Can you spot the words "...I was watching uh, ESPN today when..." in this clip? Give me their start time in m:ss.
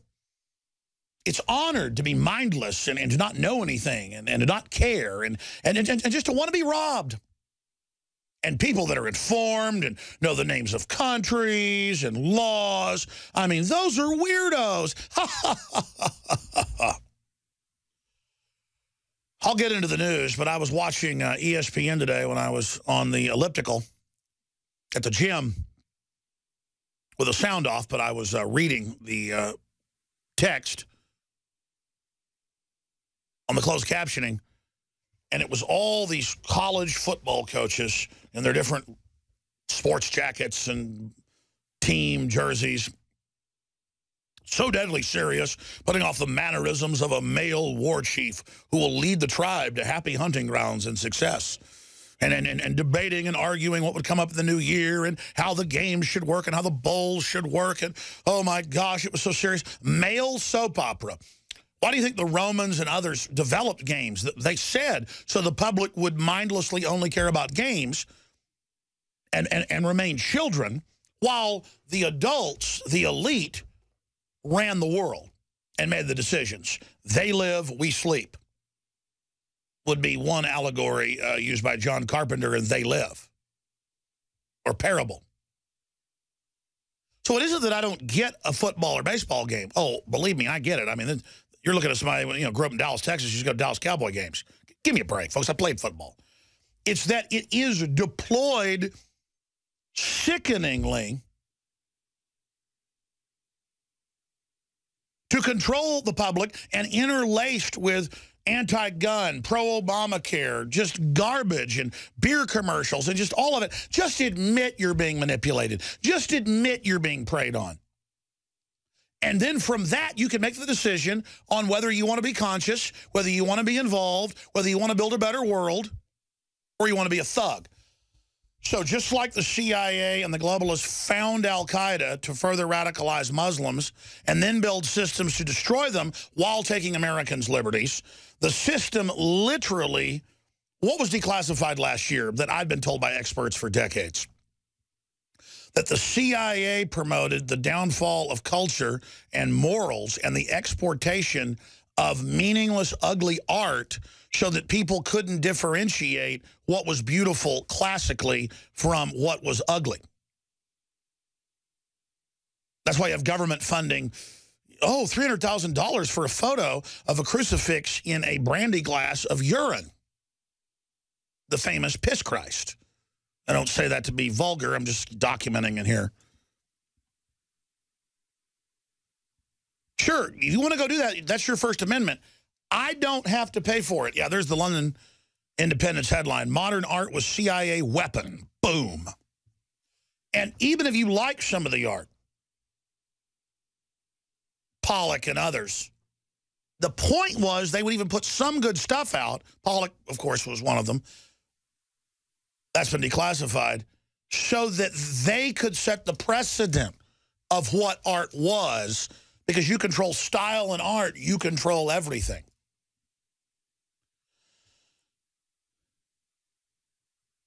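0:20.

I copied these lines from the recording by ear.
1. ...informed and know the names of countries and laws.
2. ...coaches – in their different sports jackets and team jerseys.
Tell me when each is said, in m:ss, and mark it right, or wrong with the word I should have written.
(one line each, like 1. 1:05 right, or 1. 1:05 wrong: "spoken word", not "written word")
1. 0:09 right
2. 0:37 right.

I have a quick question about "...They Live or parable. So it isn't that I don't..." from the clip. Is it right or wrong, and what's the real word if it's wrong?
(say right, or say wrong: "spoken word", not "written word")
right.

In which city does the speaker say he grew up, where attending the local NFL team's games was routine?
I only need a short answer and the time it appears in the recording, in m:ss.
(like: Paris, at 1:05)
Dallas, Texas, at 1:32.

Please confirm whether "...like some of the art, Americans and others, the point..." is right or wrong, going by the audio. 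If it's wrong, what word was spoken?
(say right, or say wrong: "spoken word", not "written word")
wrong: "Pollock", not "Americans".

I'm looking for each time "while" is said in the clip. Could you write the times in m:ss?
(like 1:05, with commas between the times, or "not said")
1:11, 2:16.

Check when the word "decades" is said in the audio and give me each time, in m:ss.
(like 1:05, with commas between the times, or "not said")
2:23.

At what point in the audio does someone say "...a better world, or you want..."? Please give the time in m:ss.
2:05.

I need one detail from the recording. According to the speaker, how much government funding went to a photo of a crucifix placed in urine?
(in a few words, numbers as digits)
$300,000.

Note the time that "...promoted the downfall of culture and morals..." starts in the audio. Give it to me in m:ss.
2:26.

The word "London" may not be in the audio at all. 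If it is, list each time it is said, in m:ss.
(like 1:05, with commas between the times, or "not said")
3:04.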